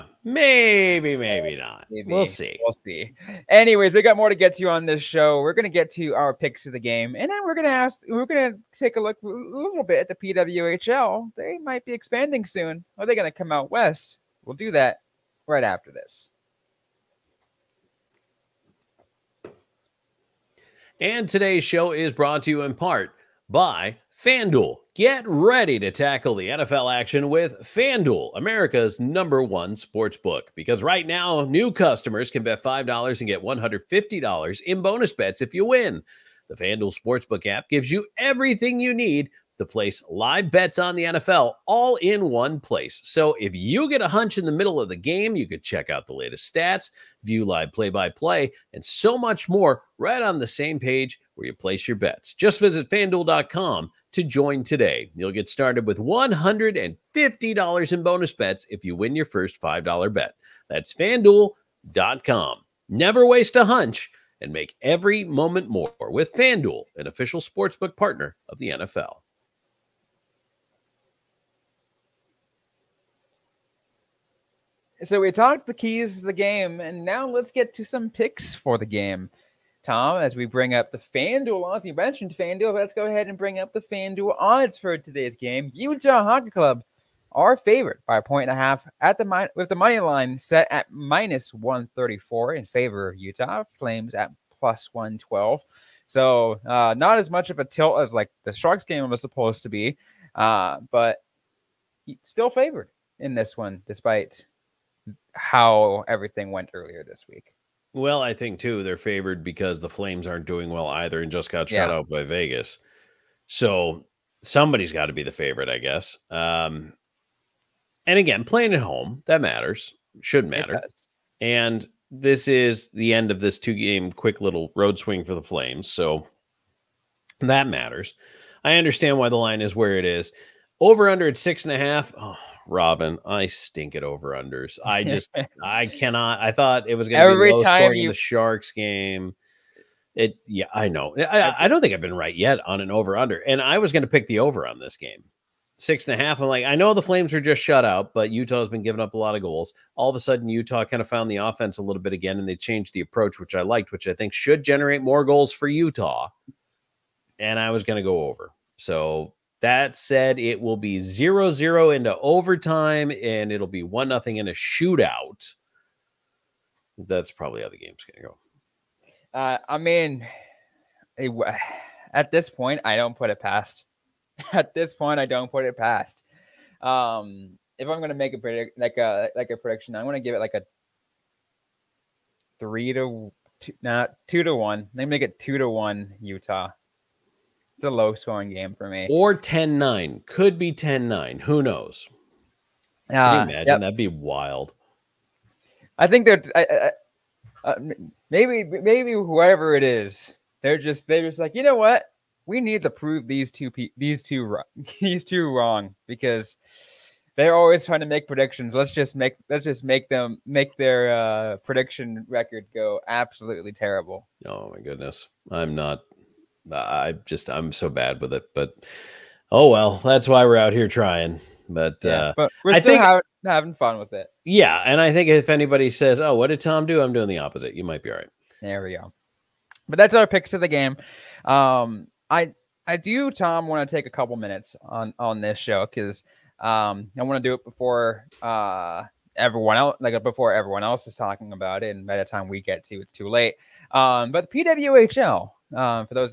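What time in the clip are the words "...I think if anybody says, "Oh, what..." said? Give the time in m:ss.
3:45.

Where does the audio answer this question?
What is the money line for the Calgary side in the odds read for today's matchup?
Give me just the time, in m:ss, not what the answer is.
1:34.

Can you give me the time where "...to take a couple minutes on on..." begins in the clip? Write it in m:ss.
3:53.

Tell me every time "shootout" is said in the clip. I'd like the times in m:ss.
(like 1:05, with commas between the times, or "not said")
2:44.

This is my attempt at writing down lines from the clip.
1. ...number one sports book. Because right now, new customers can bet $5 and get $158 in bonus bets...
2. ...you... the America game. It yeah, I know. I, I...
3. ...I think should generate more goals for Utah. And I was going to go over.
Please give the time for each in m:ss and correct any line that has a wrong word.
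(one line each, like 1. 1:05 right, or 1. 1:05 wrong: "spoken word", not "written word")
1. 0:28 wrong: "150", not "158"
2. 2:18 wrong: "Sharks", not "America"
3. 2:34 right.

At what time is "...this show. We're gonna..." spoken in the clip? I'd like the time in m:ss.
0:04.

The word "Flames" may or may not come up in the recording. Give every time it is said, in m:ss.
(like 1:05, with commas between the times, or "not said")
1:33, 1:49, 2:05, 2:27.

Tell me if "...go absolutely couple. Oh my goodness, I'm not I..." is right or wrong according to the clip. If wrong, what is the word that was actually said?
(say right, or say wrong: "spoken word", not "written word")
wrong: "terrible", not "couple".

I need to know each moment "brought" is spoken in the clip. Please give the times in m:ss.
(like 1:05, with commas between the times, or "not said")
0:22.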